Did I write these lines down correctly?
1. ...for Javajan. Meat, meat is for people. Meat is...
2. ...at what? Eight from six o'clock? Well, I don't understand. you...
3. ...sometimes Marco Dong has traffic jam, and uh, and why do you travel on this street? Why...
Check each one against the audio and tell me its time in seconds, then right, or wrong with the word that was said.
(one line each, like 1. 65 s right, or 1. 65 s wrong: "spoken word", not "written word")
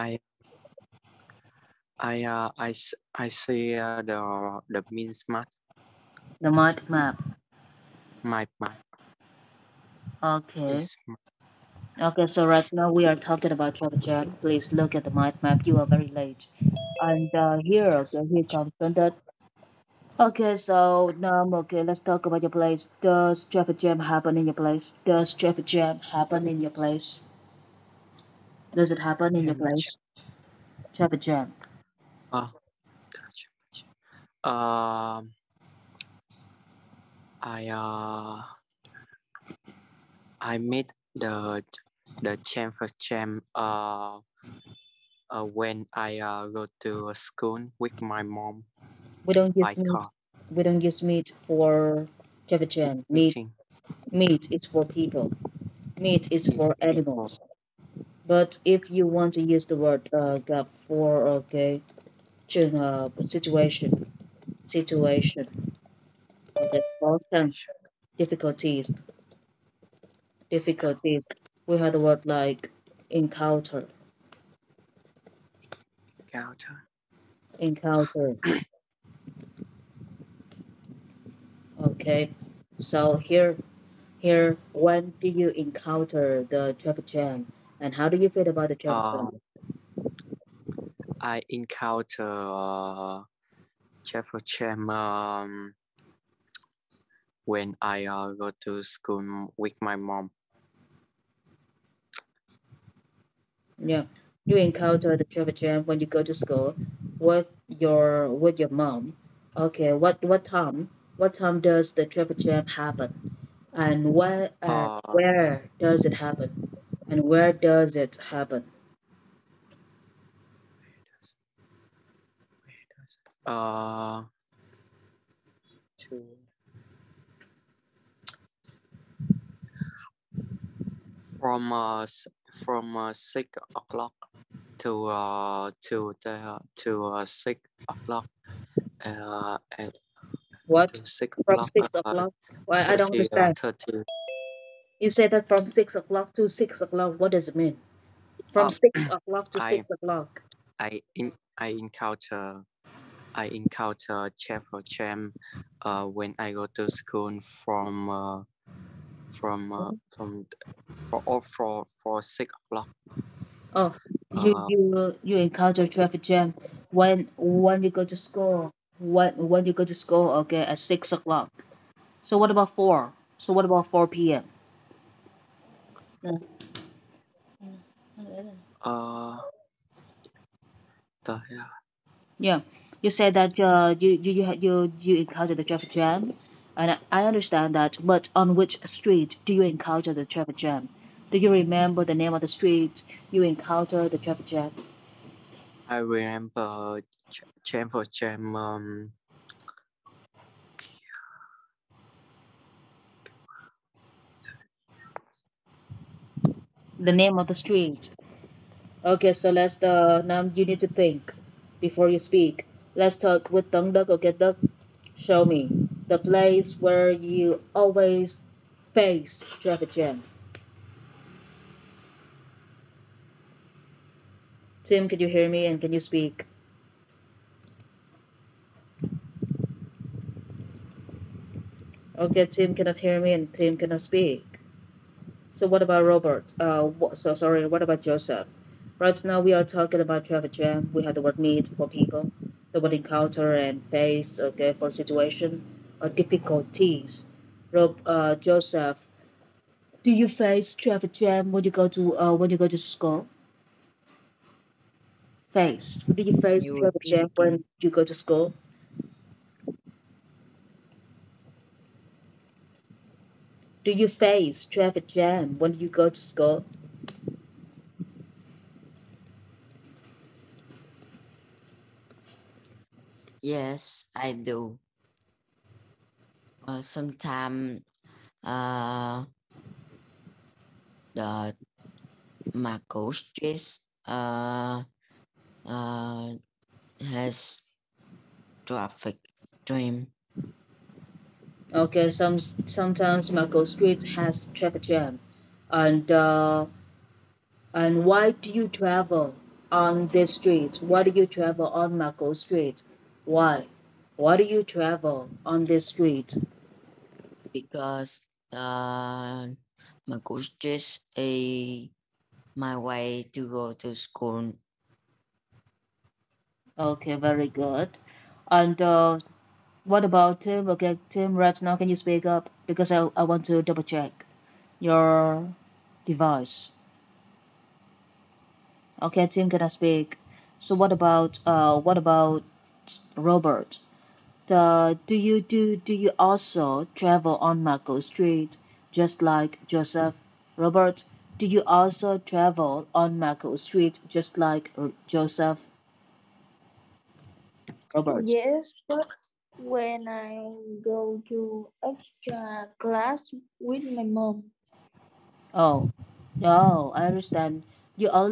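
1. 51 s right
2. 139 s wrong: "Six", not "Eight"
3. 292 s wrong: "Street", not "Dong".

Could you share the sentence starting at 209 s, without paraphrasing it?
Okay, so let's uh, now you need to think before you speak.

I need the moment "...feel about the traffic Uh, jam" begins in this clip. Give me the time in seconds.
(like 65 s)
88 s.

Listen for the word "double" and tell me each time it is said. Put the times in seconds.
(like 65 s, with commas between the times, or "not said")
323 s.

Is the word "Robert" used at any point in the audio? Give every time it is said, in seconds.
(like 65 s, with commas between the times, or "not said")
236 s, 333 s, 340 s.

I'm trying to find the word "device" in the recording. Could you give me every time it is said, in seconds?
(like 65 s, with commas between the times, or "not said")
326 s.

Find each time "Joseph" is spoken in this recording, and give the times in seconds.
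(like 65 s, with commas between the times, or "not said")
238 s, 248 s, 339 s, 345 s.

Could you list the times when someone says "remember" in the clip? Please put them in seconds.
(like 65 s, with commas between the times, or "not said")
191 s, 196 s.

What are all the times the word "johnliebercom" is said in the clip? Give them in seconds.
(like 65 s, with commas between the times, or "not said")
not said.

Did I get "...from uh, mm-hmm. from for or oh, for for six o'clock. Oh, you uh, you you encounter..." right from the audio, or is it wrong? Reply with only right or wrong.
right.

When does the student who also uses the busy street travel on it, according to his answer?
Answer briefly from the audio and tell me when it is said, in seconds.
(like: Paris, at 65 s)
extra class, at 351 s.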